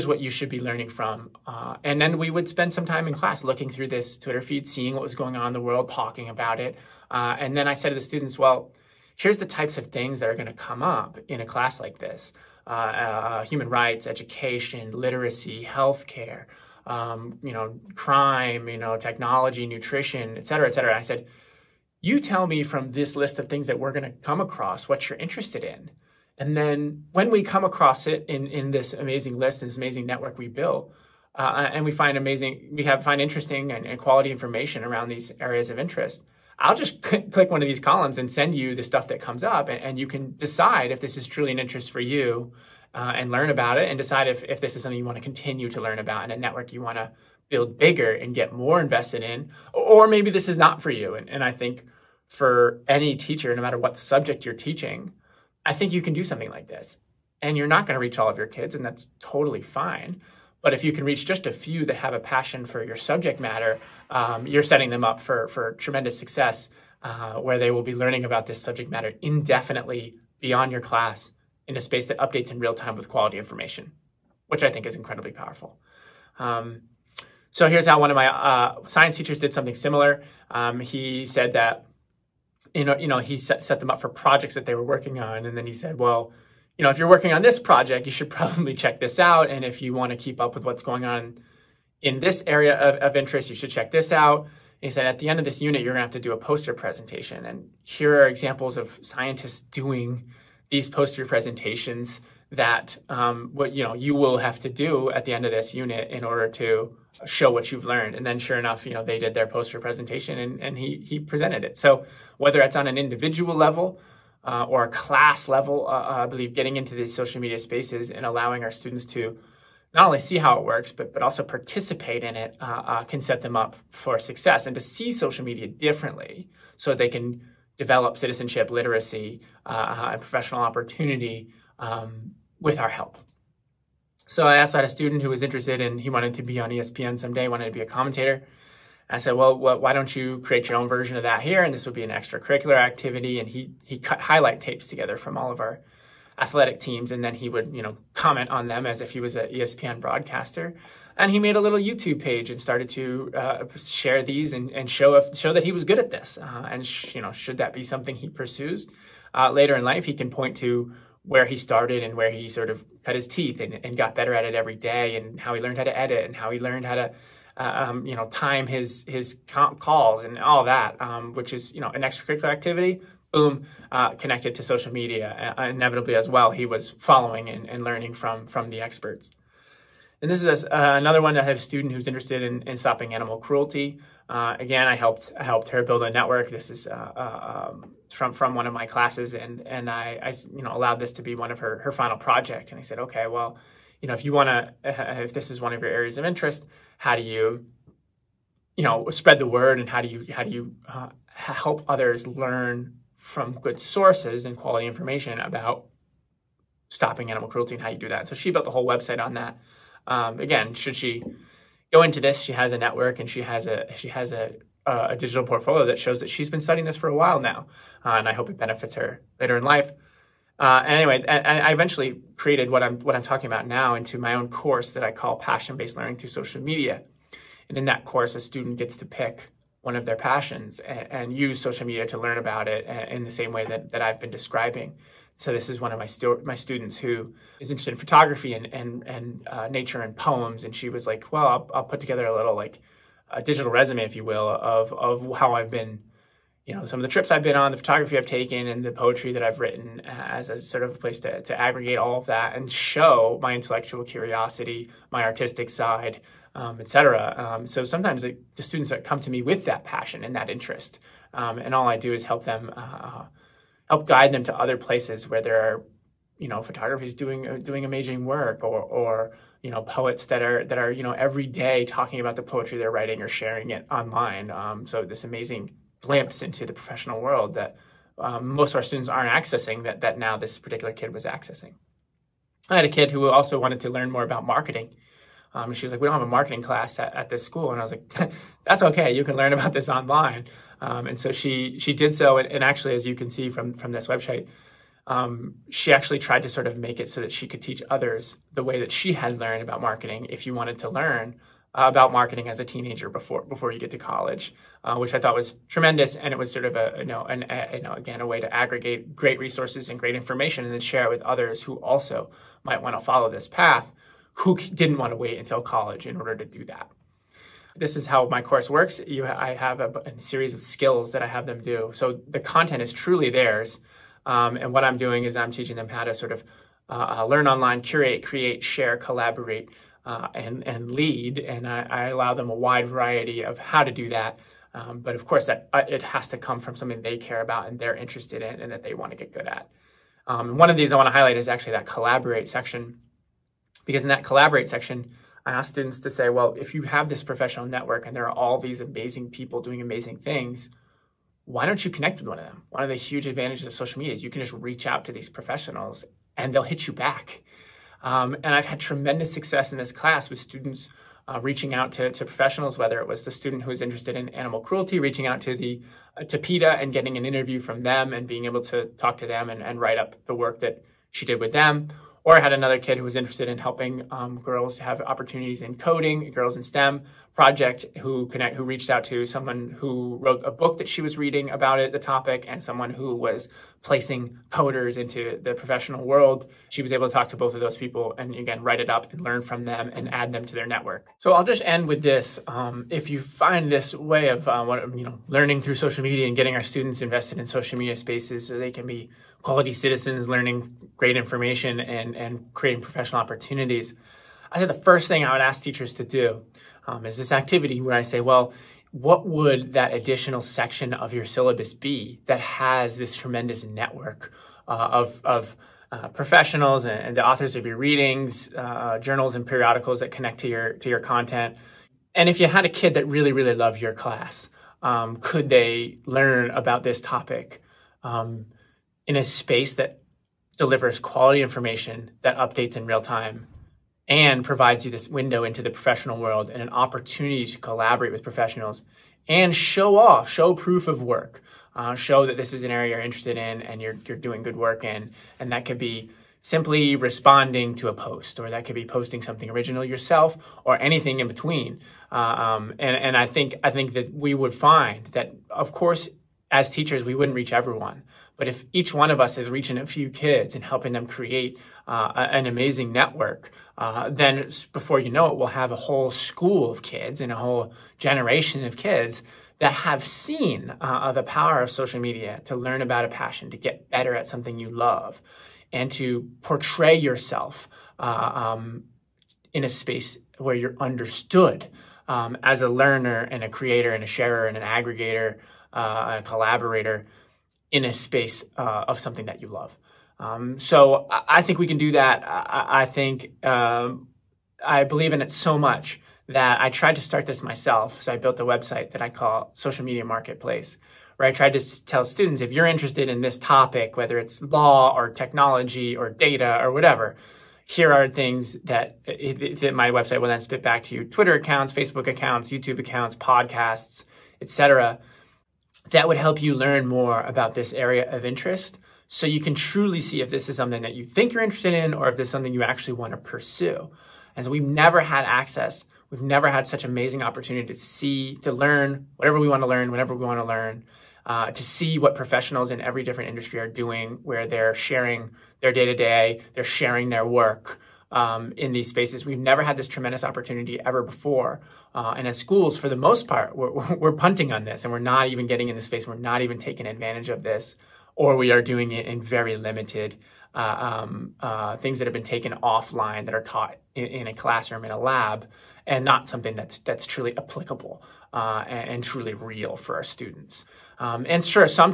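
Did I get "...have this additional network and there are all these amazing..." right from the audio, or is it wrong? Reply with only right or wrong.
wrong.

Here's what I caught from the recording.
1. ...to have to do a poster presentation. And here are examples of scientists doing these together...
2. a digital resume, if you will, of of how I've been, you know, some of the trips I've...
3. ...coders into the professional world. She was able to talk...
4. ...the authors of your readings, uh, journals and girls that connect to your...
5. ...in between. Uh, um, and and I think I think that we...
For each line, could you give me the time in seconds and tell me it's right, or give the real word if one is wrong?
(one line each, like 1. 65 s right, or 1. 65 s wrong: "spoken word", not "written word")
1. 96 s wrong: "poster", not "together"
2. 243 s right
3. 384 s right
4. 417 s wrong: "periodicals", not "girls"
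5. 451 s right.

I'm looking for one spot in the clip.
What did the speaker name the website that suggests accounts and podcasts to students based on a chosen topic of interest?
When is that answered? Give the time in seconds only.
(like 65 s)
499 s.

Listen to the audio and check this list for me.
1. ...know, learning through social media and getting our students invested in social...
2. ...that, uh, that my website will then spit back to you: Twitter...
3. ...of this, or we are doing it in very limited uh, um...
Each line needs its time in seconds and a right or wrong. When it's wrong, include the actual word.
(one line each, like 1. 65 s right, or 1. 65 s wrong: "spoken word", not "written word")
1. 395 s right
2. 508 s right
3. 547 s right.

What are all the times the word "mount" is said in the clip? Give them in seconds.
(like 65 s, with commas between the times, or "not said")
not said.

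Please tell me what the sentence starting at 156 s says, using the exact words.
Uh, and, sh- you know, should that be something he pursues?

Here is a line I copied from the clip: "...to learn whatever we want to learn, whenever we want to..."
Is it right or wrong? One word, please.
right.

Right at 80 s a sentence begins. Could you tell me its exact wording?
Um, he said that you know, you know, he set, set them up for projects that they were working on.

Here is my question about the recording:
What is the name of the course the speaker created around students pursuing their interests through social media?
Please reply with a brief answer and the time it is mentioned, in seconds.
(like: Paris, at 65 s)
Passion-Based Learning Through Social Media, at 225 s.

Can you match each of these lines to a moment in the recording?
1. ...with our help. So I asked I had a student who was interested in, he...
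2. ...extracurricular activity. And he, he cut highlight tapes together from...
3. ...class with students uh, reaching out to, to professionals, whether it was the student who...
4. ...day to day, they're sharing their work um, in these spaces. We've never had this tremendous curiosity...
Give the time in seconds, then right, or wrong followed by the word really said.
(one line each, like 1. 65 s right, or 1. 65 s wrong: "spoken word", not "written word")
1. 132 s right
2. 142 s right
3. 359 s right
4. 535 s wrong: "opportunity", not "curiosity".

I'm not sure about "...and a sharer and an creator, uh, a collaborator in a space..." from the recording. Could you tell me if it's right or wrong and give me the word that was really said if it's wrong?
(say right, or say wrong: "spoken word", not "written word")
wrong: "aggregator", not "creator".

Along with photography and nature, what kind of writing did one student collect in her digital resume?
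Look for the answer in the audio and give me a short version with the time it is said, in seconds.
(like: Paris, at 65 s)
Poems, at 240 s.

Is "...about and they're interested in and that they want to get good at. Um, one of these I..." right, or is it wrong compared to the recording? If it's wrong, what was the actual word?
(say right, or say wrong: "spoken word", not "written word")
right.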